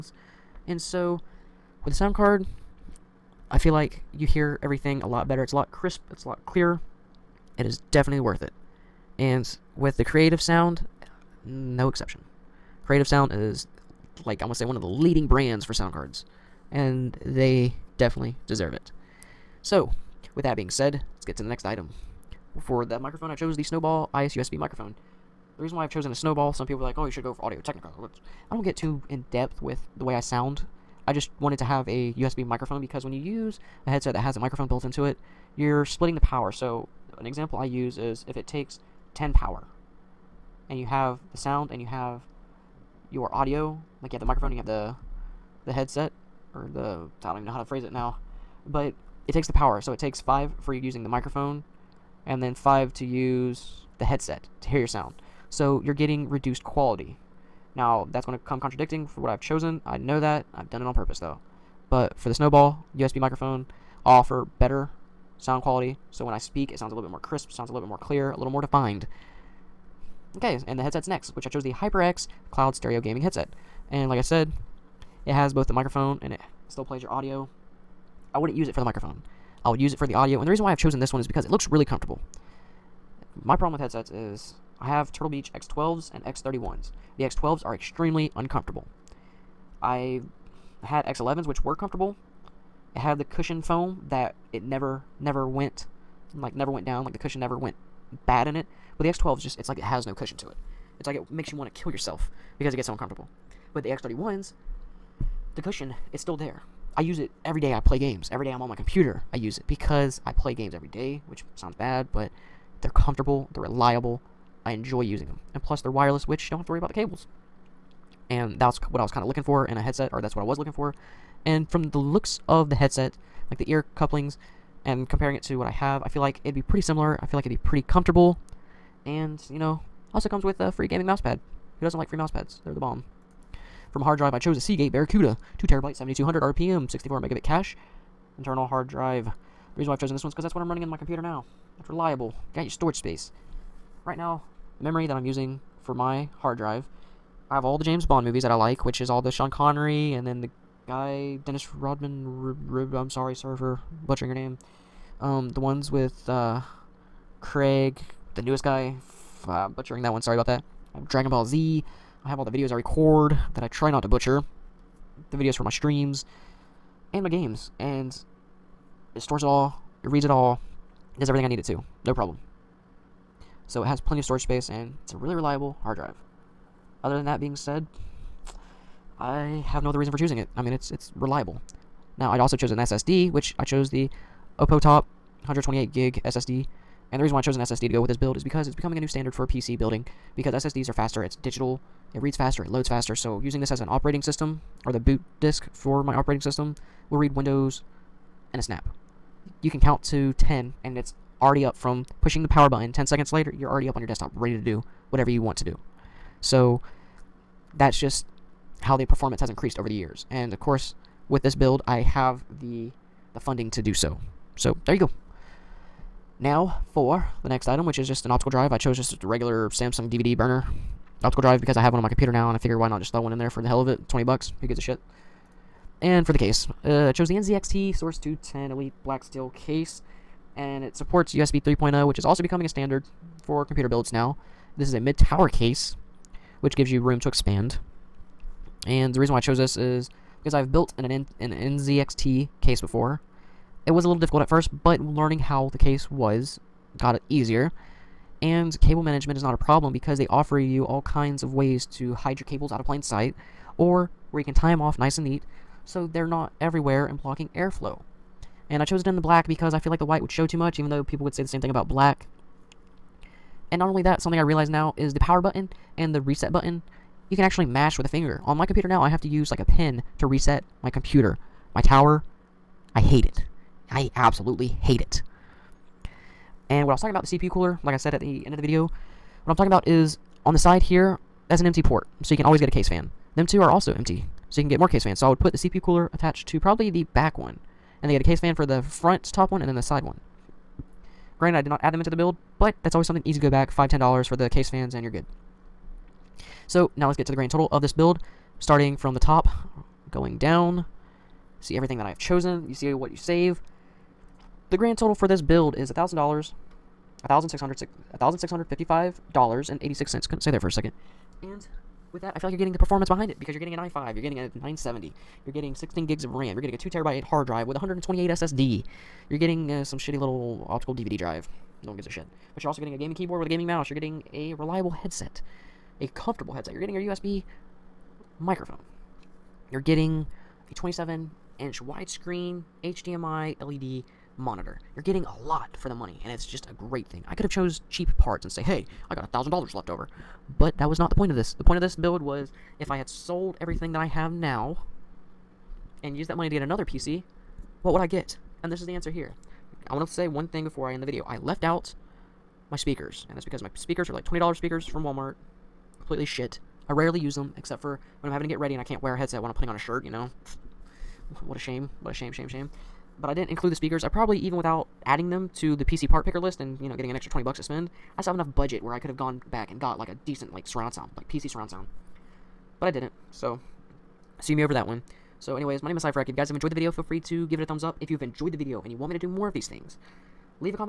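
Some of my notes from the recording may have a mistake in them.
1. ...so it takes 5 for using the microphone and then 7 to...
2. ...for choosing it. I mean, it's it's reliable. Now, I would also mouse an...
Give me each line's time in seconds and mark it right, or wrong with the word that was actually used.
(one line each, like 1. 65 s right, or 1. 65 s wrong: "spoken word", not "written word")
1. 49 s wrong: "5", not "7"
2. 180 s wrong: "chose", not "mouse".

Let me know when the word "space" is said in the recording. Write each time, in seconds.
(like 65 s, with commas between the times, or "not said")
142 s, 174 s.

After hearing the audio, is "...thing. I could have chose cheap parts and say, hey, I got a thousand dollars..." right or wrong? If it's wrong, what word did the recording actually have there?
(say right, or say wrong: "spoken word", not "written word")
right.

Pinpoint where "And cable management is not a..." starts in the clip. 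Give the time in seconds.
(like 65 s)
248 s.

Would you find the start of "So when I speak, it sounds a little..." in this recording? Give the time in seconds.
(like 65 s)
66 s.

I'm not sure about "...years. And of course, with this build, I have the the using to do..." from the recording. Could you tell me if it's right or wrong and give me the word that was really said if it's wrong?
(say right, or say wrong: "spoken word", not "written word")
wrong: "funding", not "using".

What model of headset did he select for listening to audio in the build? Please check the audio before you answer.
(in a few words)
HyperX Cloud Stereo.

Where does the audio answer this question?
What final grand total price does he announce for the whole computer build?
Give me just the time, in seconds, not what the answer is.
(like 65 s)
307 s.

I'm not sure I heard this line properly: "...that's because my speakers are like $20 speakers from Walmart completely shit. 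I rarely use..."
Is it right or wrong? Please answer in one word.
right.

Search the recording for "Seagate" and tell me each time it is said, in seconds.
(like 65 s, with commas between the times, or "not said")
134 s.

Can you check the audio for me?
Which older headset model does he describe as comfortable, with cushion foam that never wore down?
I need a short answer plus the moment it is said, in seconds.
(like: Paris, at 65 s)
X11s, at 91 s.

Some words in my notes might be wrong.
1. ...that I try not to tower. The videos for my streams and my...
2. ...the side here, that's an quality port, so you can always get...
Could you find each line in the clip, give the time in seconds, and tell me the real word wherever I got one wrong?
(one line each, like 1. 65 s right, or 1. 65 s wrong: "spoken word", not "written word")
1. 163 s wrong: "butcher", not "tower"
2. 280 s wrong: "empty", not "quality".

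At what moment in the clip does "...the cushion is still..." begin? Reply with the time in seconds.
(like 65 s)
105 s.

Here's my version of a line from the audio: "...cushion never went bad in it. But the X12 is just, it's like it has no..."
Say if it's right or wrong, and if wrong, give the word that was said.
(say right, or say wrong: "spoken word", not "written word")
right.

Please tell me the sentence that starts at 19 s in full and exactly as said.
So, with that being said, let's get to the next item.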